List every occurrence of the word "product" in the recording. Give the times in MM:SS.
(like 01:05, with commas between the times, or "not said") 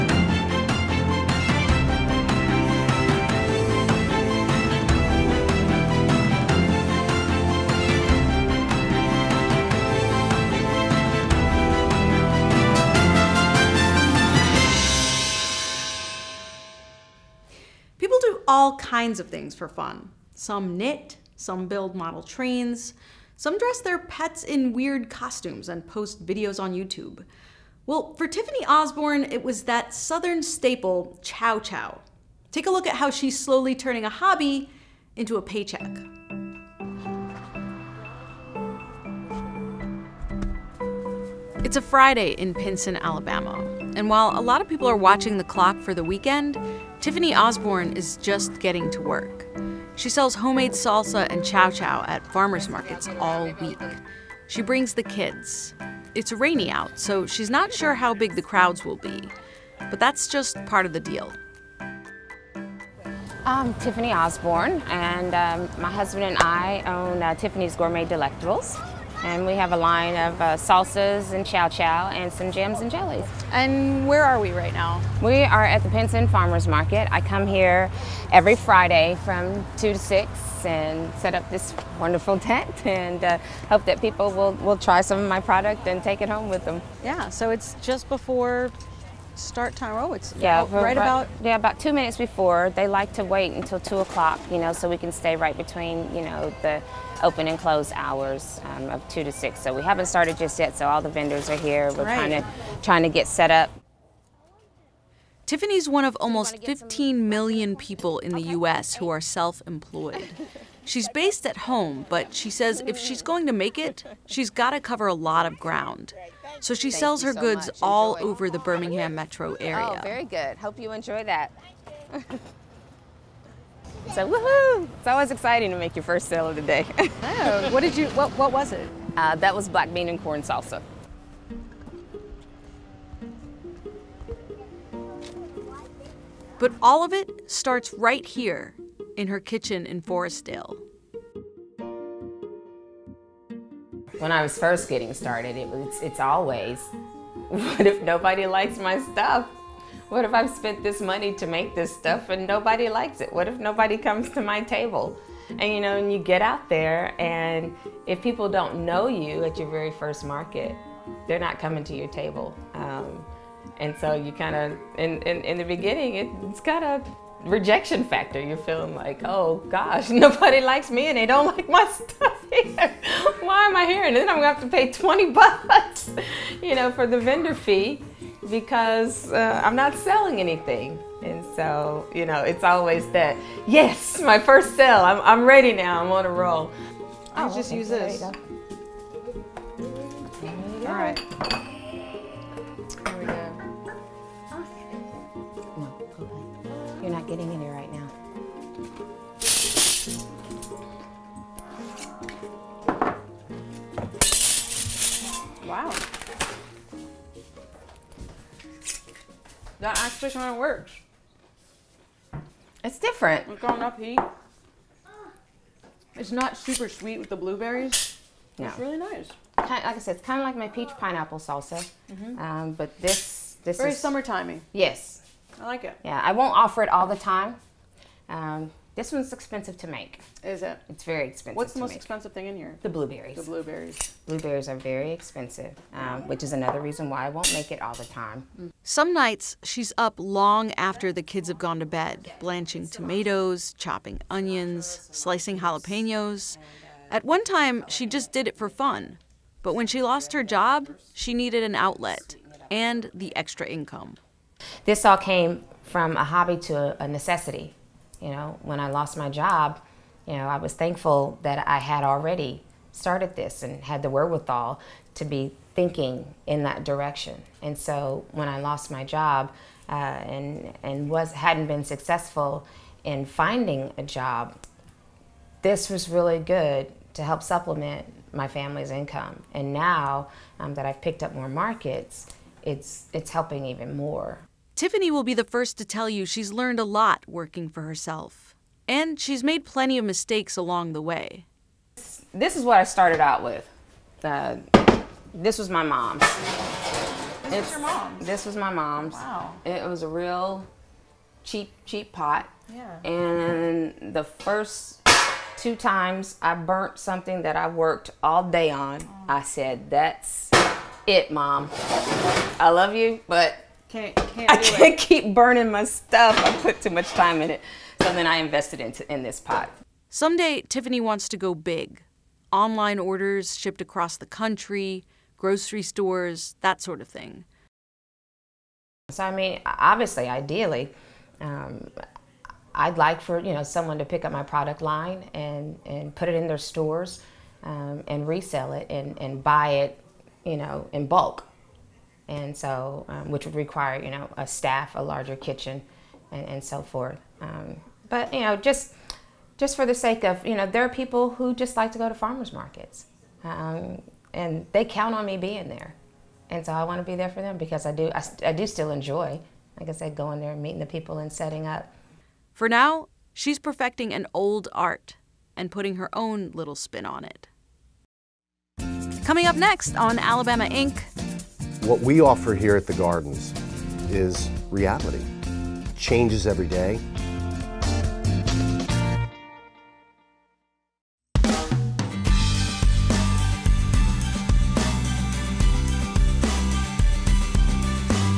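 01:25, 05:34.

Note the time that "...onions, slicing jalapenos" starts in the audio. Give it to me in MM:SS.
04:04.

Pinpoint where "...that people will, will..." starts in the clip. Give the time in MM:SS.
01:23.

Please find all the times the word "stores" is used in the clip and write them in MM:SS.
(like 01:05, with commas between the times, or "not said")
05:25, 05:36.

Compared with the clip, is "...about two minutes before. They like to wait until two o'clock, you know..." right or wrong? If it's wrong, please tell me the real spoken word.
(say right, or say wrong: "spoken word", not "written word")
right.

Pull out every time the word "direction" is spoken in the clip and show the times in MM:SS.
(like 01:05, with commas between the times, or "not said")
04:26.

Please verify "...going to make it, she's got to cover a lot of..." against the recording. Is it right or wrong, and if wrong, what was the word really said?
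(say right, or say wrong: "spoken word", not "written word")
right.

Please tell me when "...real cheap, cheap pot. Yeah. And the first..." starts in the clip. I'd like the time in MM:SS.
05:00.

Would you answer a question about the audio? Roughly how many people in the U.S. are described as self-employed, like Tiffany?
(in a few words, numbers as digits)
15 million.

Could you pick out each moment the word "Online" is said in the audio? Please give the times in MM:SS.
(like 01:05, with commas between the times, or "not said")
05:22.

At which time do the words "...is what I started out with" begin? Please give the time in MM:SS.
04:52.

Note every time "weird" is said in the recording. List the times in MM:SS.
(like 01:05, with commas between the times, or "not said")
00:24.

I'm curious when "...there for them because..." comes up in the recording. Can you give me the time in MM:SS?
05:57.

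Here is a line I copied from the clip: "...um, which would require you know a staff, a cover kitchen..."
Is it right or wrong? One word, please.
wrong.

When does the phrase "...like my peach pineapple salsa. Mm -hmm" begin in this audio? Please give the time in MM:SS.
03:40.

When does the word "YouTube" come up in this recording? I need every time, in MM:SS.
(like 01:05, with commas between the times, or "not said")
00:26.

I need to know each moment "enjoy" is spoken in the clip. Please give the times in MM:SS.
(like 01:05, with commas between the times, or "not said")
02:00, 05:58.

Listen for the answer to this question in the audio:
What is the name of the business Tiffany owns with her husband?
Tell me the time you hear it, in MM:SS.
01:07.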